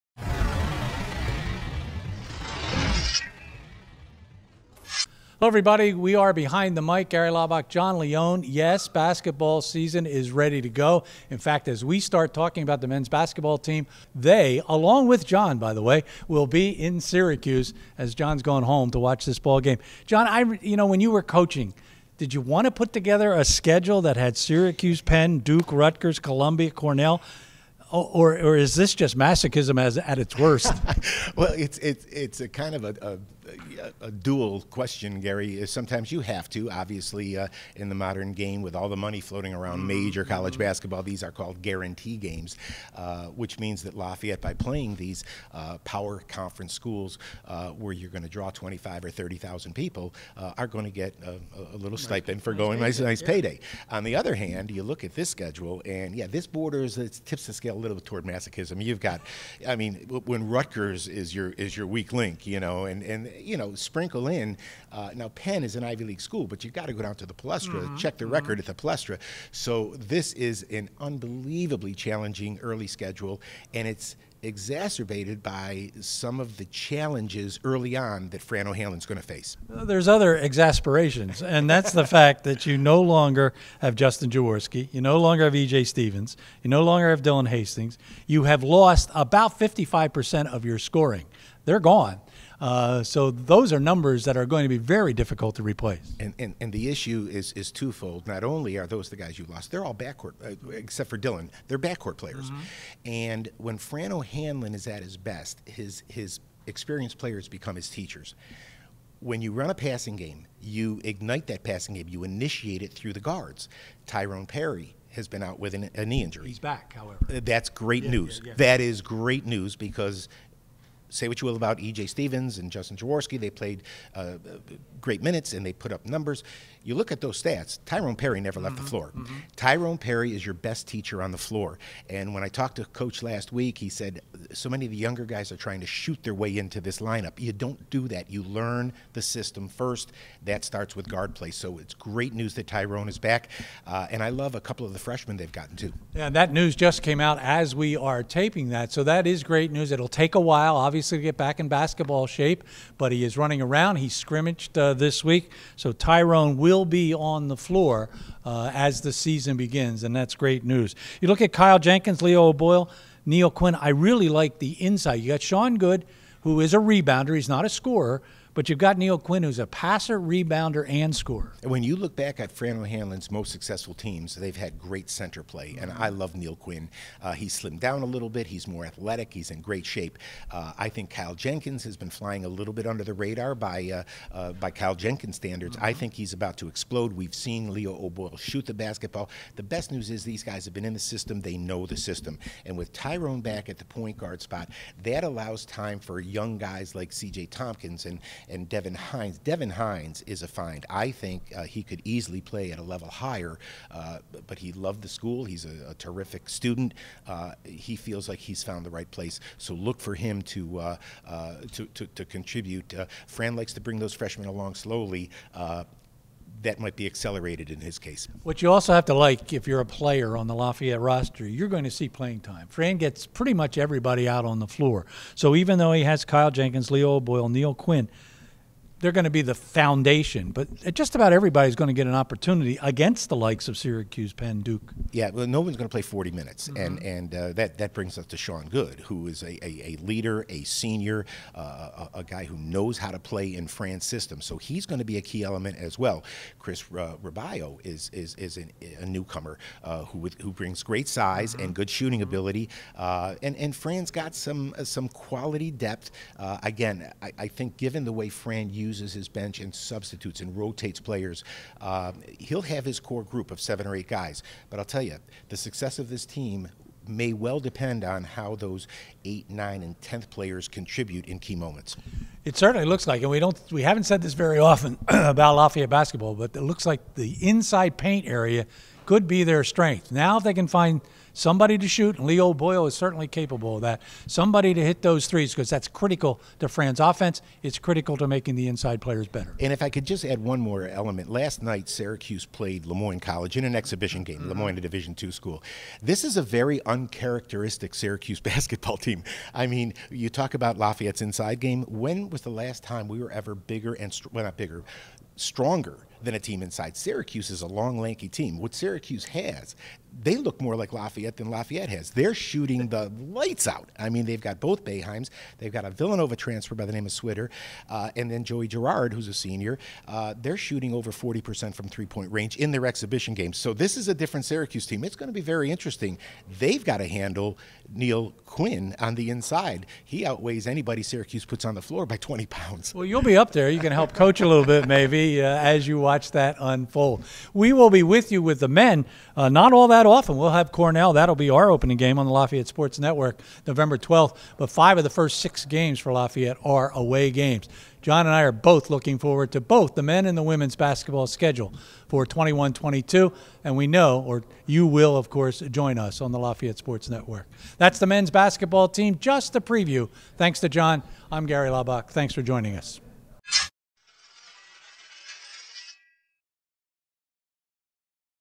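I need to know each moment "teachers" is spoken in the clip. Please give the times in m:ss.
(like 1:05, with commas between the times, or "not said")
1:47, 2:10.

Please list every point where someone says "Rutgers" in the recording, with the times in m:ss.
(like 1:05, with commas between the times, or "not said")
0:25, 1:00.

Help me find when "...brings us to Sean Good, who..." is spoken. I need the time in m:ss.
3:57.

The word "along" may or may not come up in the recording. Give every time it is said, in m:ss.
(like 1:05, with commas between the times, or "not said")
0:14, 3:34.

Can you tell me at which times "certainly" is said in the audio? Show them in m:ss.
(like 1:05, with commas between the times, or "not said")
4:32, 4:42.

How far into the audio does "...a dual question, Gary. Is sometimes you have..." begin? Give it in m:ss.
0:34.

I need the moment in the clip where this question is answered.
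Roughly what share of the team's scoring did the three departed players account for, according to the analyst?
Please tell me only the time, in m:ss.
1:29.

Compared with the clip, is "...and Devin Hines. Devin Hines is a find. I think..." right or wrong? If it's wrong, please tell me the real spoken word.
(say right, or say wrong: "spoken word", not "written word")
right.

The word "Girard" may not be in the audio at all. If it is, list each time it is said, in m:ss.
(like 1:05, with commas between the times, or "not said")
5:18.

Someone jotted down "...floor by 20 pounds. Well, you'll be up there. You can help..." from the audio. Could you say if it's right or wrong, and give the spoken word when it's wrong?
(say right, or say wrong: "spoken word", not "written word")
right.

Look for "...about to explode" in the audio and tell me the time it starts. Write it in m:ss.
3:06.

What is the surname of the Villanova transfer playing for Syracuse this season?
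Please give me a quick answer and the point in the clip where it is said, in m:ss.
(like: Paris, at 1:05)
Swider, at 5:17.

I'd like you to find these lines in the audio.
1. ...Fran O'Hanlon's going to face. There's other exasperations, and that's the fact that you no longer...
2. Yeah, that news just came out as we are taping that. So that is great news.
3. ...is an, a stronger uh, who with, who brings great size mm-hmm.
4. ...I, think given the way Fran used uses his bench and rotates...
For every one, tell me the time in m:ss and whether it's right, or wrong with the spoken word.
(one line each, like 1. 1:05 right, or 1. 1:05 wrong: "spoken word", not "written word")
1. 1:18 right
2. 2:26 right
3. 4:08 wrong: "newcomer", not "stronger"
4. 4:17 wrong: "substitutes", not "rotates".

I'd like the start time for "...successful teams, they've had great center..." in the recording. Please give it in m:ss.
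2:53.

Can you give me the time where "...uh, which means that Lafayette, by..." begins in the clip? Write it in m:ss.
0:42.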